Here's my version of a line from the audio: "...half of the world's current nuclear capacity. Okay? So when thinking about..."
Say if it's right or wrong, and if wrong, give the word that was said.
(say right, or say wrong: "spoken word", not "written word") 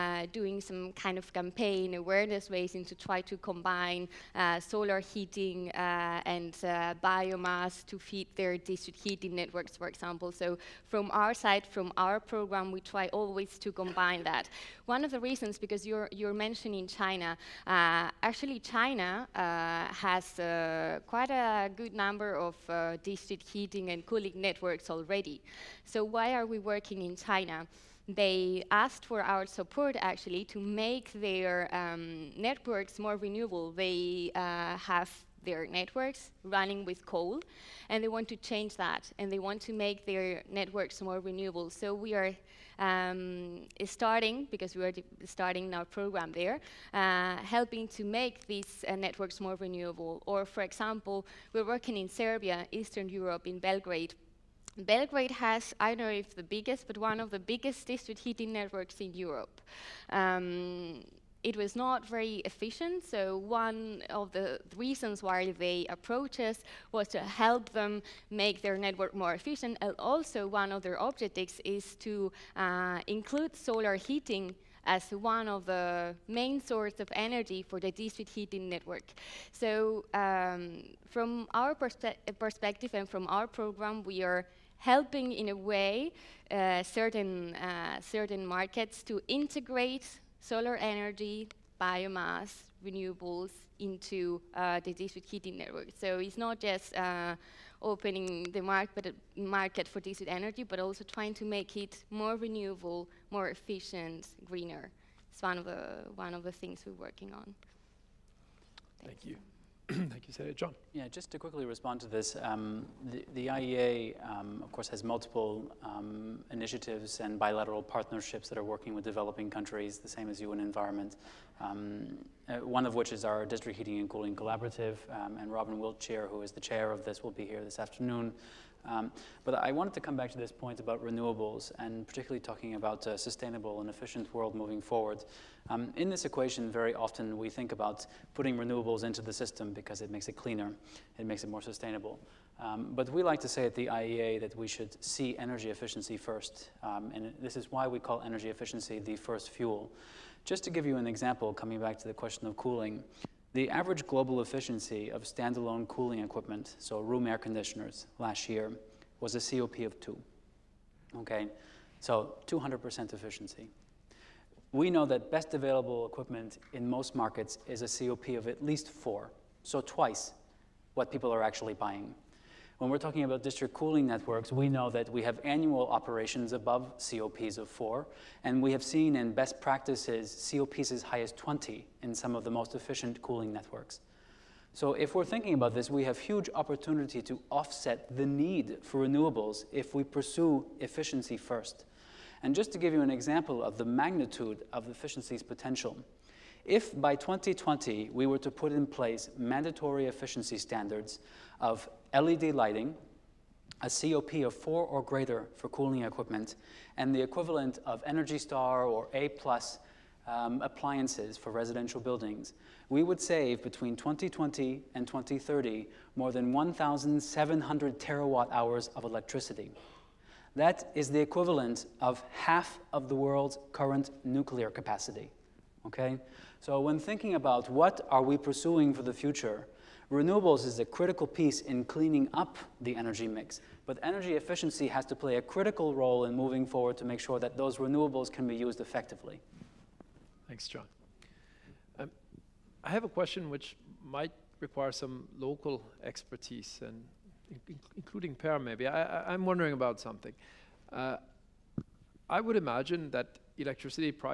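right.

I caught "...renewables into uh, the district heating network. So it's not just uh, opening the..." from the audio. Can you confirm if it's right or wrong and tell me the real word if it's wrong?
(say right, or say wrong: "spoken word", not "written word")
right.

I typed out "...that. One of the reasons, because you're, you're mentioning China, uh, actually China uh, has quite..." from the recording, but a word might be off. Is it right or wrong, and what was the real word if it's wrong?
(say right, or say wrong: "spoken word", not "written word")
right.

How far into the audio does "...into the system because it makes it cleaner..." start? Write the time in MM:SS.
02:19.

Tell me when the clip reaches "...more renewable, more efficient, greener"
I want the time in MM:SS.
01:42.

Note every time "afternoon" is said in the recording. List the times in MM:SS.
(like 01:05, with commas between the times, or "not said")
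02:07.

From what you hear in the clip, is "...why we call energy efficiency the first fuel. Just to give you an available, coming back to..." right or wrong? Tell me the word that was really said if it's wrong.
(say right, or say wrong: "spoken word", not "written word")
wrong: "example", not "available".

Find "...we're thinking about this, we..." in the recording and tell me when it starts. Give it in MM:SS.
03:05.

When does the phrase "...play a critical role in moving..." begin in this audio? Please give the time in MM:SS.
03:55.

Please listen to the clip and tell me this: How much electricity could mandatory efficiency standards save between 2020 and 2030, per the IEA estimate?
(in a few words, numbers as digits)
1,700 terawatt hours.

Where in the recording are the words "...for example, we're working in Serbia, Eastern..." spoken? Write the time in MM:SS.
00:50.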